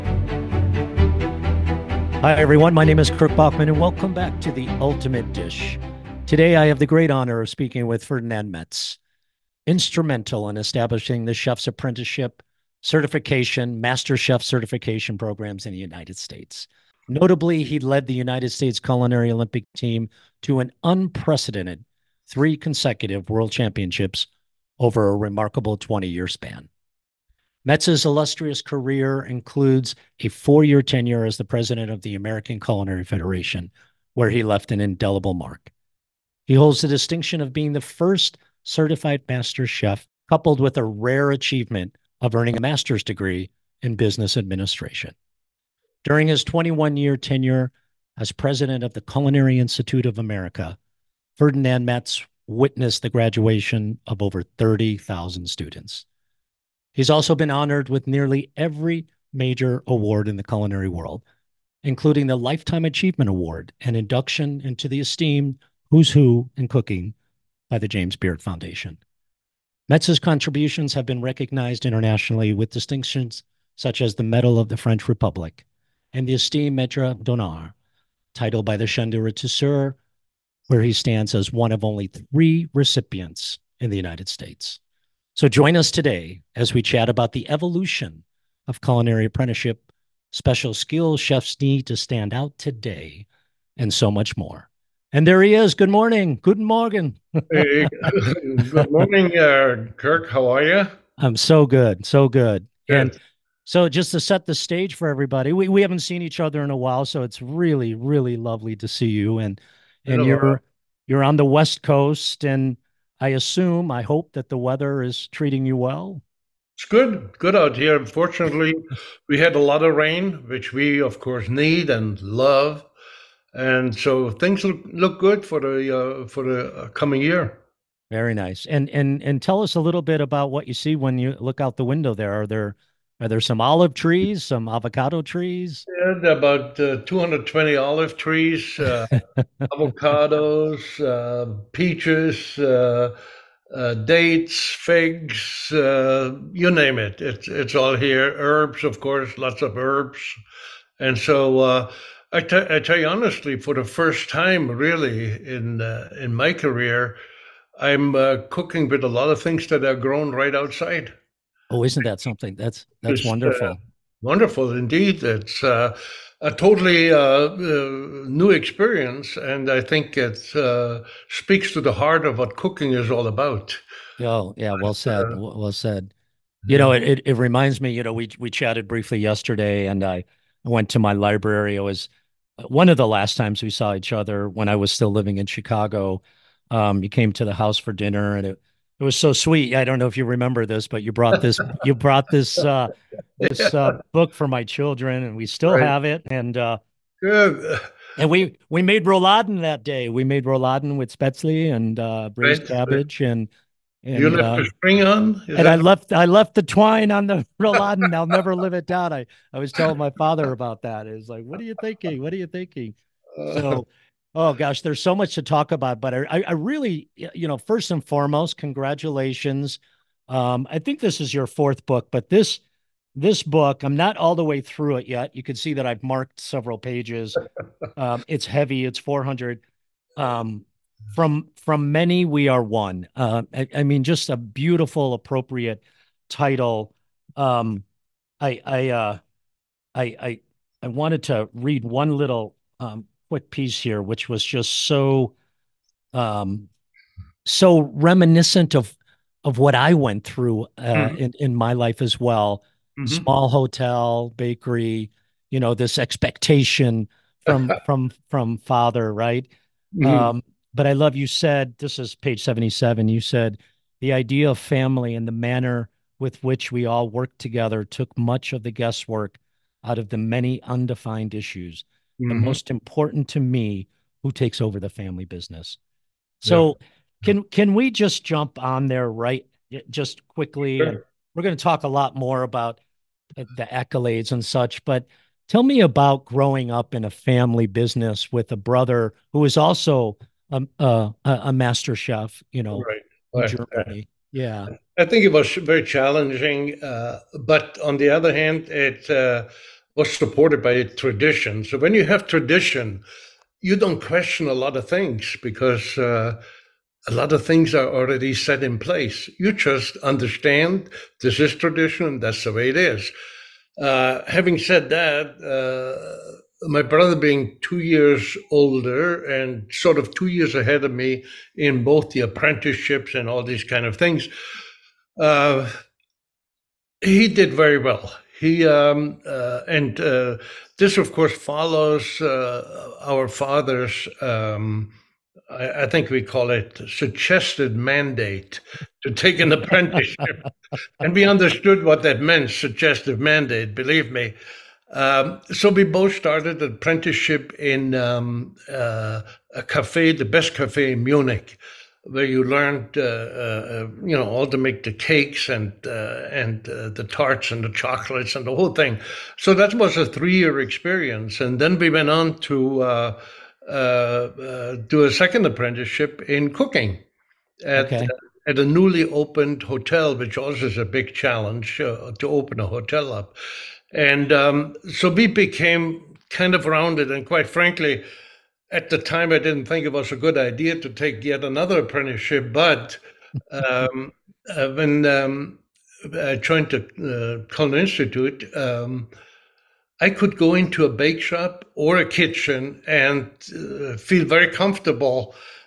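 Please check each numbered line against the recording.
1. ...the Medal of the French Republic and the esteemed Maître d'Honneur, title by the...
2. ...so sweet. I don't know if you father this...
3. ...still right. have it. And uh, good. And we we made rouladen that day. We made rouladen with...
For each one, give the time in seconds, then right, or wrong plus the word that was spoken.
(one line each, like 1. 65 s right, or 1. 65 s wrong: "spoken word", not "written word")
1. 74 s right
2. 189 s wrong: "remember", not "father"
3. 195 s right.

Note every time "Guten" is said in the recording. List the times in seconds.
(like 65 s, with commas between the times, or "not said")
96 s.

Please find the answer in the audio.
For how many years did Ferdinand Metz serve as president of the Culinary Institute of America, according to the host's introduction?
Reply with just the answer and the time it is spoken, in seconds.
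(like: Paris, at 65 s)
21, at 46 s.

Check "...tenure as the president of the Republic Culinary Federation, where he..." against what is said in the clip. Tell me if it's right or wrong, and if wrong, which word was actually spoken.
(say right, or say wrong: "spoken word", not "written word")
wrong: "American", not "Republic".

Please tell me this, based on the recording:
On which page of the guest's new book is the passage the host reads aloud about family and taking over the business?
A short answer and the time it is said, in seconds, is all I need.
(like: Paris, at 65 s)
77, at 262 s.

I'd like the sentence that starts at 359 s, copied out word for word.
So that was a three-year experience, and then we went on to uh, do a second apprenticeship in cooking at okay.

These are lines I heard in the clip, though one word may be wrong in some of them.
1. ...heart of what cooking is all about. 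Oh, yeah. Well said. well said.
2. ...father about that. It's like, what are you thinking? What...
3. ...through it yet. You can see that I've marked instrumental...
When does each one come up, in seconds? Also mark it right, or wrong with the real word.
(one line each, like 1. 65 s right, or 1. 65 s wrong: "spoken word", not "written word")
1. 171 s right
2. 210 s right
3. 224 s wrong: "several", not "instrumental".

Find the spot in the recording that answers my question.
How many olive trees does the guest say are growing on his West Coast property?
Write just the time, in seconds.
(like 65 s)
137 s.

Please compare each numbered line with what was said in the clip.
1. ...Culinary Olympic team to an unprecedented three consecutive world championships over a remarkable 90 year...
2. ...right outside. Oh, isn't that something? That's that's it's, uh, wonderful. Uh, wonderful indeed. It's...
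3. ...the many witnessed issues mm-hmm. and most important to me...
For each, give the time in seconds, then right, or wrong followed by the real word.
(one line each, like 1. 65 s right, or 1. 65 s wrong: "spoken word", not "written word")
1. 18 s wrong: "20", not "90"
2. 160 s right
3. 270 s wrong: "undefined", not "witnessed".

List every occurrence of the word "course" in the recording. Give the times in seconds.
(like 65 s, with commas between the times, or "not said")
121 s, 149 s, 331 s.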